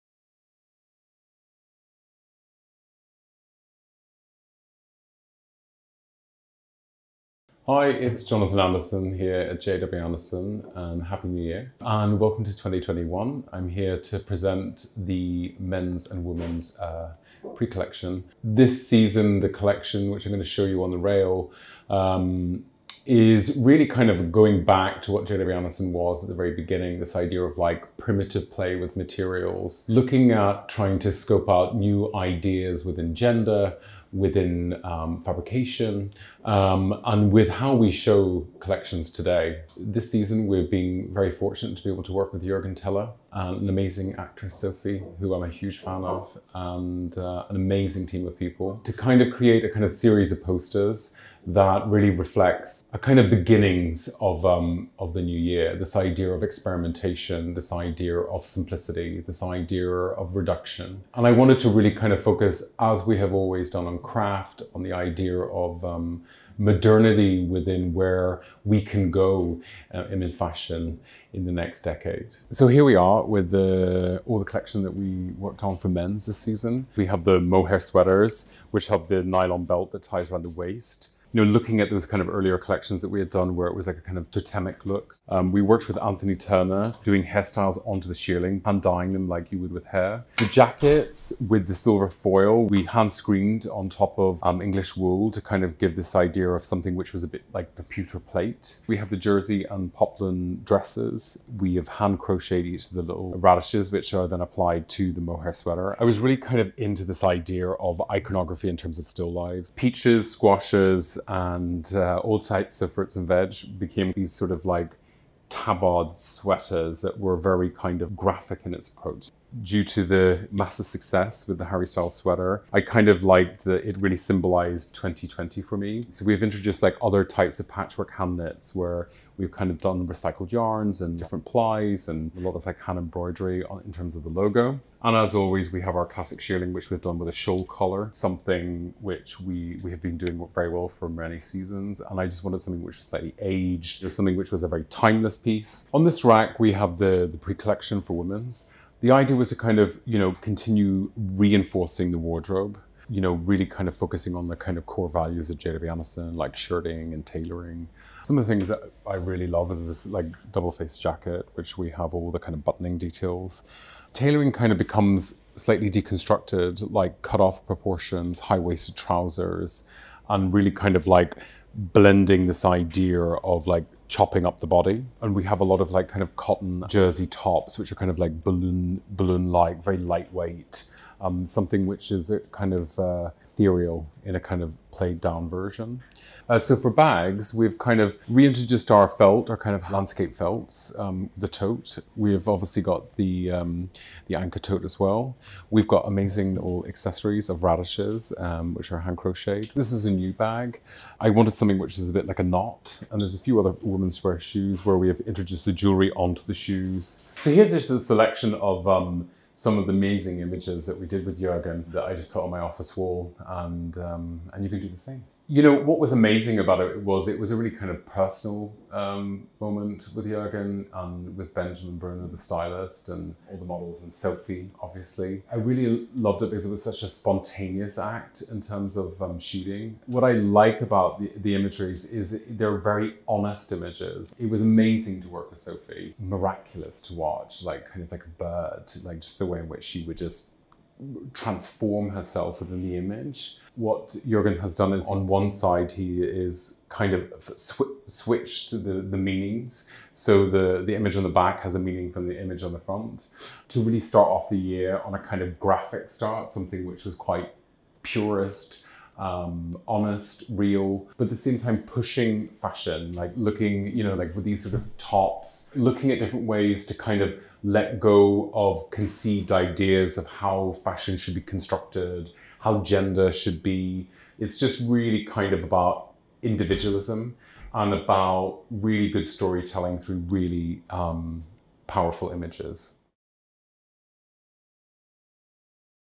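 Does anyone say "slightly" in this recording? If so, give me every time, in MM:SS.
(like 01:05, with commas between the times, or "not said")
02:23, 02:45.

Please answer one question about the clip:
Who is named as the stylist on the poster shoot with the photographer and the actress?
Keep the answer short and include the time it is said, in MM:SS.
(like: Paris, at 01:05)
Benjamin Bruno, at 03:41.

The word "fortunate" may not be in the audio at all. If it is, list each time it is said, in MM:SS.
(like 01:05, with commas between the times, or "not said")
00:41.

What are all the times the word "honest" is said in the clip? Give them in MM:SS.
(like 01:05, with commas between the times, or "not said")
03:53, 04:19.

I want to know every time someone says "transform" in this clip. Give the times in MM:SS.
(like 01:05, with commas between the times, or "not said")
04:01.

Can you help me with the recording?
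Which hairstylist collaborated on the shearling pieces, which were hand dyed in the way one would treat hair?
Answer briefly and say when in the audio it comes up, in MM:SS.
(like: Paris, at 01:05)
Anthony Turner, at 01:26.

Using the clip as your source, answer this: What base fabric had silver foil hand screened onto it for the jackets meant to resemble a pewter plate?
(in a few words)
English wool.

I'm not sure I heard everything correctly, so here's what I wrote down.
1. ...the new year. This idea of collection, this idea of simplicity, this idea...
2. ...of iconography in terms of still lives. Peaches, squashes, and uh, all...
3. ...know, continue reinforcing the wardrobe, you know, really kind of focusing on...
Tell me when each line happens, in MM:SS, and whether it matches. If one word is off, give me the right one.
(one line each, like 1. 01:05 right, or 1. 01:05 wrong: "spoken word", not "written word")
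1. 00:55 wrong: "experimentation", not "collection"
2. 01:47 right
3. 02:30 right.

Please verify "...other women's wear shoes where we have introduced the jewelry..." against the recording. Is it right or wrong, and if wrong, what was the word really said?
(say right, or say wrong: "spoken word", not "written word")
right.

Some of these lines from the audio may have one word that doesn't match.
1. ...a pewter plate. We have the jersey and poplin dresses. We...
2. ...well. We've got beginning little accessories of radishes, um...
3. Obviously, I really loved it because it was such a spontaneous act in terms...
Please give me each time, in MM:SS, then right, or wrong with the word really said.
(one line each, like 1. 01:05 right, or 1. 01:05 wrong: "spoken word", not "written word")
1. 01:37 right
2. 03:14 wrong: "amazing", not "beginning"
3. 03:44 right.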